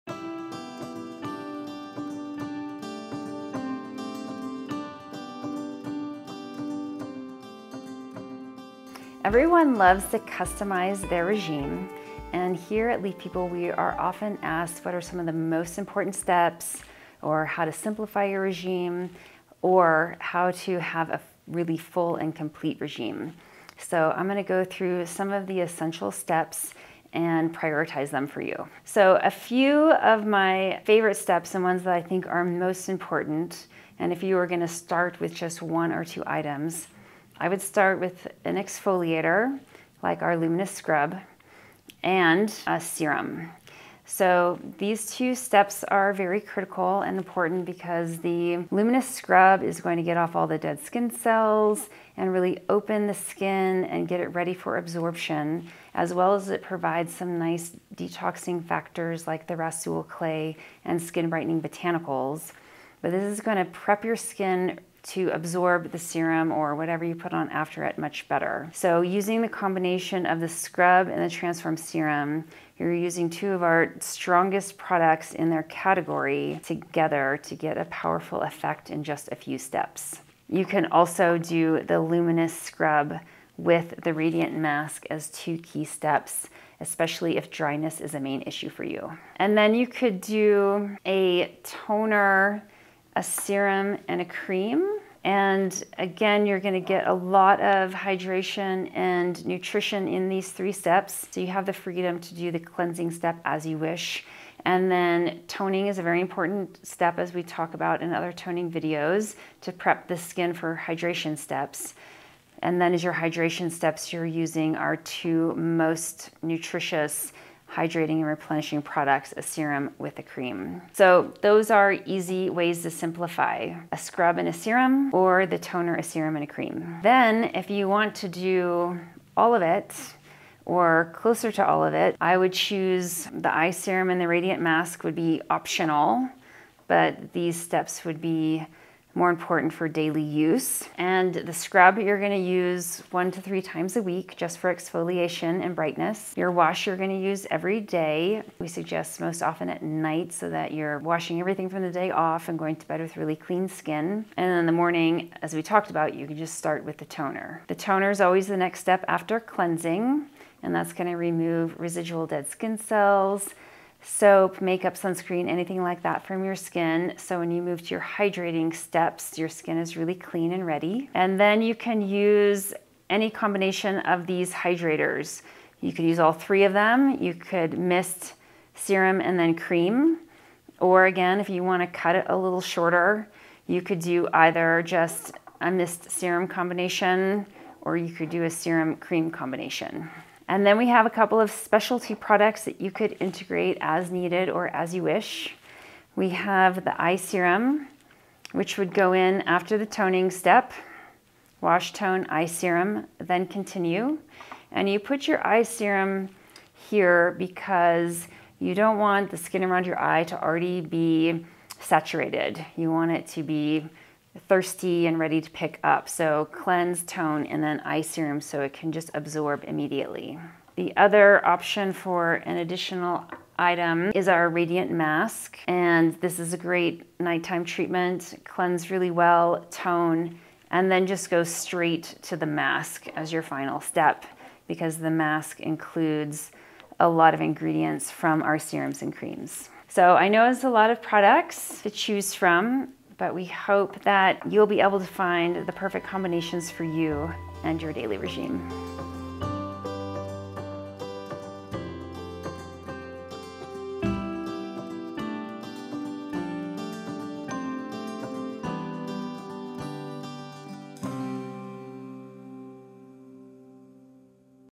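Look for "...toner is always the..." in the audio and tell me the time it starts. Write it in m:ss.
2:37.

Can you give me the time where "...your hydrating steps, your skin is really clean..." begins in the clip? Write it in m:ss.
2:47.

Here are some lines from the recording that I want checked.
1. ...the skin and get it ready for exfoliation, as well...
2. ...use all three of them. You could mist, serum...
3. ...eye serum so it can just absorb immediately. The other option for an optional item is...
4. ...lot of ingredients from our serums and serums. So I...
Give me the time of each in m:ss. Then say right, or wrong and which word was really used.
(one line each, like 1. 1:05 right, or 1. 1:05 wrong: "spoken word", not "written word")
1. 0:53 wrong: "absorption", not "exfoliation"
2. 2:56 right
3. 3:37 wrong: "additional", not "optional"
4. 3:57 wrong: "creams", not "serums".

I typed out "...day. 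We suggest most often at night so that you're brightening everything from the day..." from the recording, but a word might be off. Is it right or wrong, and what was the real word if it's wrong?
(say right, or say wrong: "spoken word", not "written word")
wrong: "washing", not "brightening".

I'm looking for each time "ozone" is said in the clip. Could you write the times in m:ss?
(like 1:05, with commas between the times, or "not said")
not said.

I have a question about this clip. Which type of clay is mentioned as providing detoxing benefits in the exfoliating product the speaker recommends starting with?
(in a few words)
Rasool clay.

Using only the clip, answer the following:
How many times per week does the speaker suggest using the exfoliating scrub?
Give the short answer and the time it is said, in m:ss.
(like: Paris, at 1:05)
1 to 3 times, at 2:23.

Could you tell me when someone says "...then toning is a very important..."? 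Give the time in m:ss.
1:44.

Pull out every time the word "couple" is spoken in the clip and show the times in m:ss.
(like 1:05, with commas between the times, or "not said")
3:11.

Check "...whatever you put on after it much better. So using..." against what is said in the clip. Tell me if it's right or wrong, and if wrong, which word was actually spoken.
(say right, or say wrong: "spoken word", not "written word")
right.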